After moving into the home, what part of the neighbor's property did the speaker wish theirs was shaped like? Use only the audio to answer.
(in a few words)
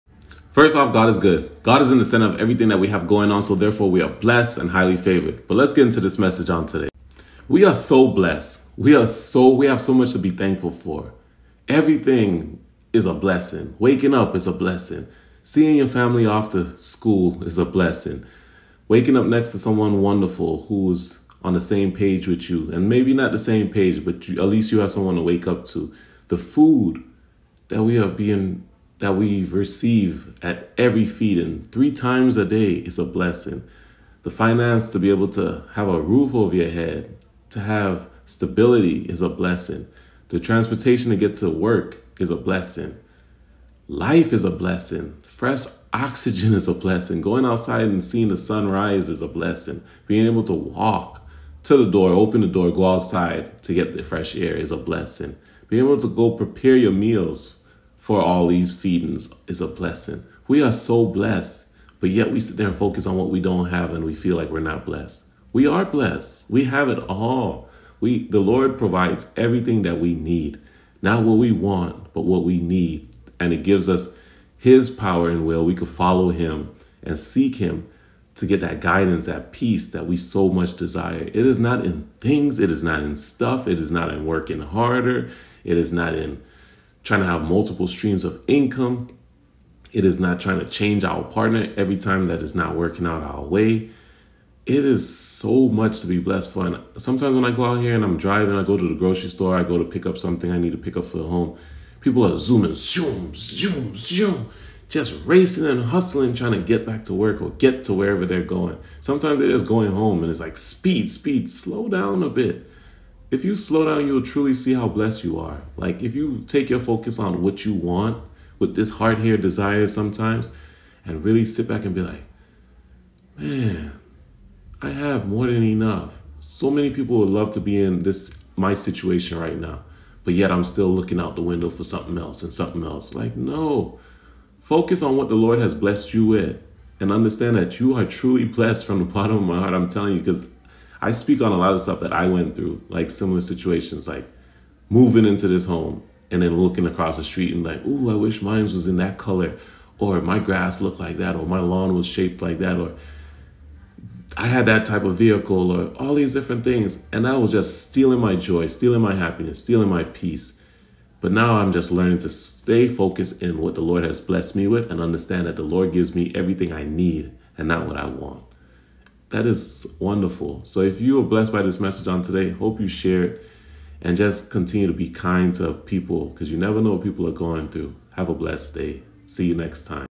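lawn.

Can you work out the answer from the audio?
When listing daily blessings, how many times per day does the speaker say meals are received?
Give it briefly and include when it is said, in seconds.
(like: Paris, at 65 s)
3, at 31 s.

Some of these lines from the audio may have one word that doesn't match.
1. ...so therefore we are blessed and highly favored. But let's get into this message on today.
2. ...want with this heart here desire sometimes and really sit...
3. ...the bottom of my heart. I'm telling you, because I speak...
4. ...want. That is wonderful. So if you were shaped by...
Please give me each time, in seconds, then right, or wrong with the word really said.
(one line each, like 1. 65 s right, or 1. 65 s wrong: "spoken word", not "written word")
1. 3 s right
2. 117 s right
3. 138 s right
4. 168 s wrong: "blessed", not "shaped".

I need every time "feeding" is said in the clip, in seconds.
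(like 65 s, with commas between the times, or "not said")
31 s, 58 s.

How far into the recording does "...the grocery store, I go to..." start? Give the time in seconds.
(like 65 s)
98 s.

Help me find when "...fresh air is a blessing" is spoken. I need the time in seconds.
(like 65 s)
54 s.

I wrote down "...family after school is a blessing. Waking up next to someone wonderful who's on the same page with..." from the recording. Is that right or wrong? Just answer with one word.
right.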